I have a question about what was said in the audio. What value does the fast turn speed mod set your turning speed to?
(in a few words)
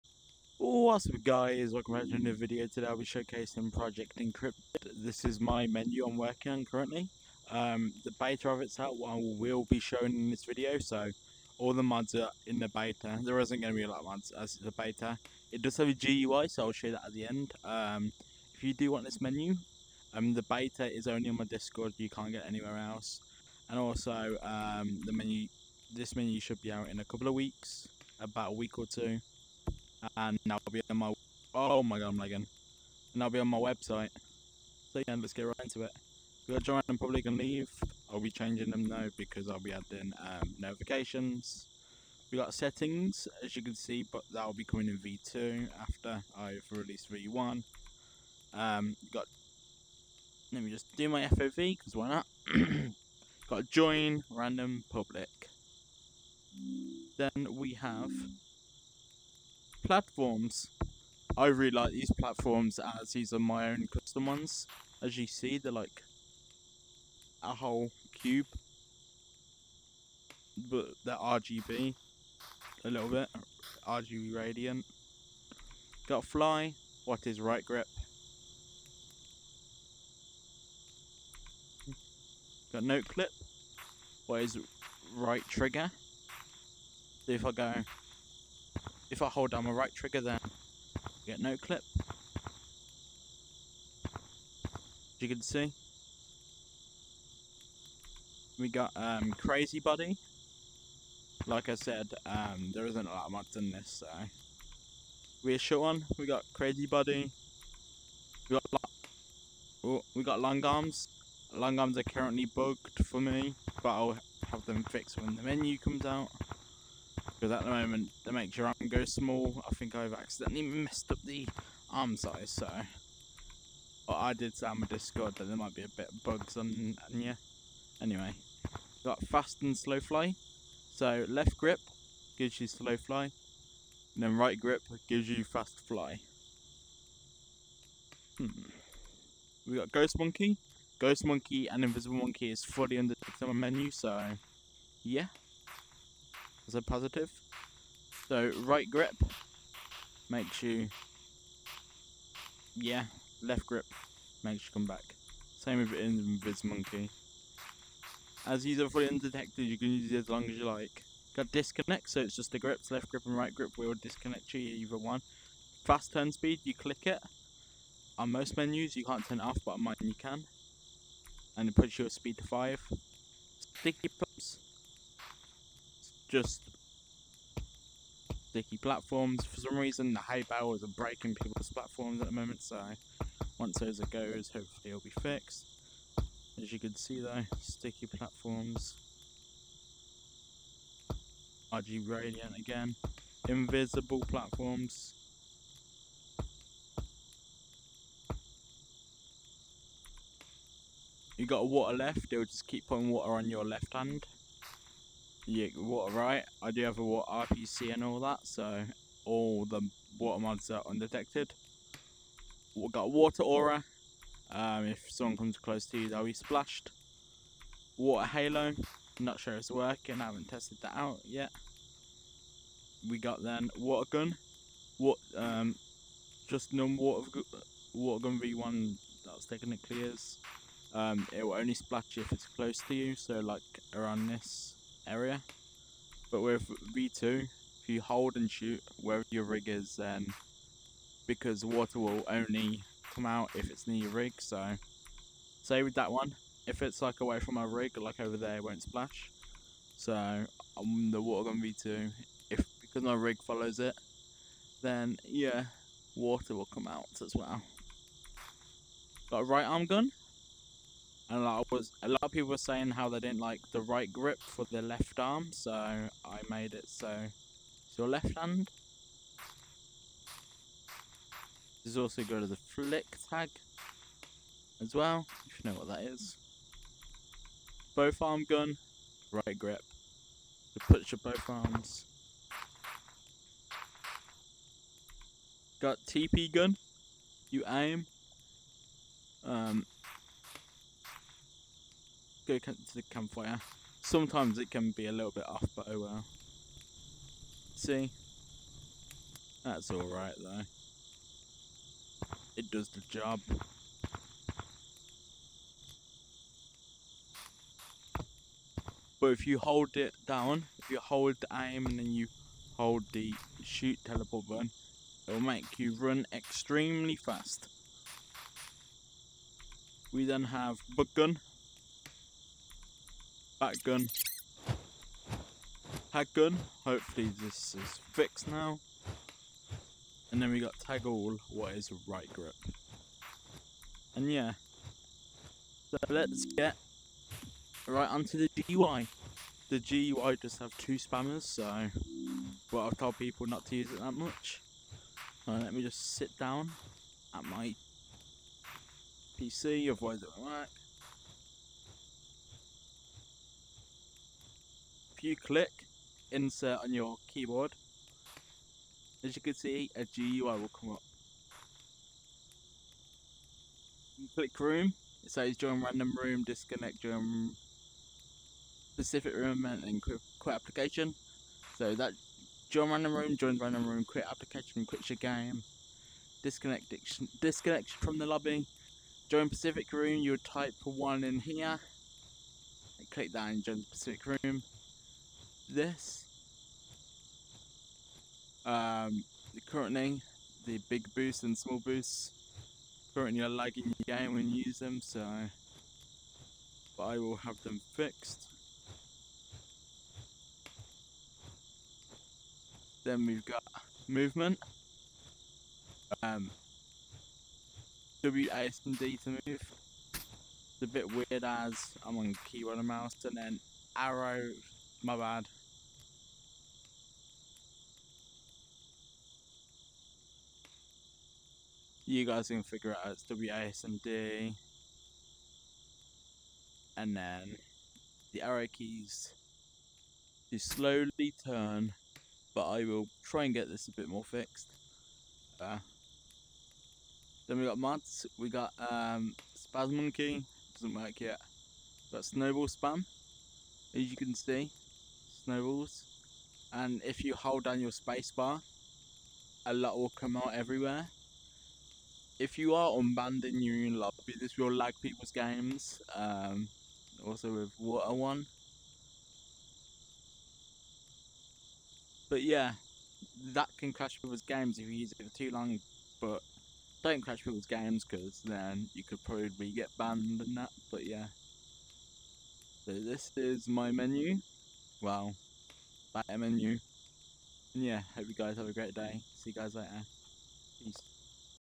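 5.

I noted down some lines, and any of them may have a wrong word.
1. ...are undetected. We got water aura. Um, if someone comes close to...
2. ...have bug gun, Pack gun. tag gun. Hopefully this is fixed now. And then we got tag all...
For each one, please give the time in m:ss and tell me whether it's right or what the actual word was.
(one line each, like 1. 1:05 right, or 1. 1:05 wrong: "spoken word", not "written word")
1. 3:30 right
2. 5:20 right.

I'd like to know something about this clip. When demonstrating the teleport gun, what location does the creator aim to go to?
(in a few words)
the campfire.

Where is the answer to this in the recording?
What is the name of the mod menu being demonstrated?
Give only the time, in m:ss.
0:03.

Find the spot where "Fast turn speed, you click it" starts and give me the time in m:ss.
2:45.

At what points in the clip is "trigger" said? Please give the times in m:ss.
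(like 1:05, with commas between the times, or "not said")
1:25, 1:29.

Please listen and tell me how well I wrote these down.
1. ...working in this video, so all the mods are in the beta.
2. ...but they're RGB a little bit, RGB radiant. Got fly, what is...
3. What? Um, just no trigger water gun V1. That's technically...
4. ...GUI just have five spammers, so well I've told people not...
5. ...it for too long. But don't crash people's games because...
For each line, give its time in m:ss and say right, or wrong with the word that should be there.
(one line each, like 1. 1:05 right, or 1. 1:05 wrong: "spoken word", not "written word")
1. 0:09 wrong: "showing", not "working"
2. 1:10 right
3. 3:44 wrong: "water", not "trigger"
4. 5:39 wrong: "two", not "five"
5. 7:45 right.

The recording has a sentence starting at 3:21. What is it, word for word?
You got water left, it'll just keep putting water on your left hand yeah, water right.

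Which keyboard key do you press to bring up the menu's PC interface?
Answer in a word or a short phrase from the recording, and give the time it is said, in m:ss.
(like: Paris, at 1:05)
insert, at 5:56.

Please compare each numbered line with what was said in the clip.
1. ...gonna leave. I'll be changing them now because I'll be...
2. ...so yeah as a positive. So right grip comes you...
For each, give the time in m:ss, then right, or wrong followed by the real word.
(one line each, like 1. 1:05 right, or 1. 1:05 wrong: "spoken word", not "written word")
1. 0:37 right
2. 2:23 wrong: "makes", not "comes".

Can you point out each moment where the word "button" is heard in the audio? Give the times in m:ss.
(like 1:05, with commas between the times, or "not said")
5:14.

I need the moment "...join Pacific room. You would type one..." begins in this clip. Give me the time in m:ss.
6:19.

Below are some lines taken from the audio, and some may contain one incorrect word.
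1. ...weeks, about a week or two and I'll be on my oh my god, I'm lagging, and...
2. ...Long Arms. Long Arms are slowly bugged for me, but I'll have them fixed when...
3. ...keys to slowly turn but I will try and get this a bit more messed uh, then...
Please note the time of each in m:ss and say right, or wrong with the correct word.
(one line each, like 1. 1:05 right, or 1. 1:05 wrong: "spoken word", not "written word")
1. 0:27 right
2. 1:50 wrong: "currently", not "slowly"
3. 7:08 wrong: "fixed", not "messed".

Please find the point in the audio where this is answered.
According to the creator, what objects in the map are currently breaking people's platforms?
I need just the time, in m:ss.
3:00.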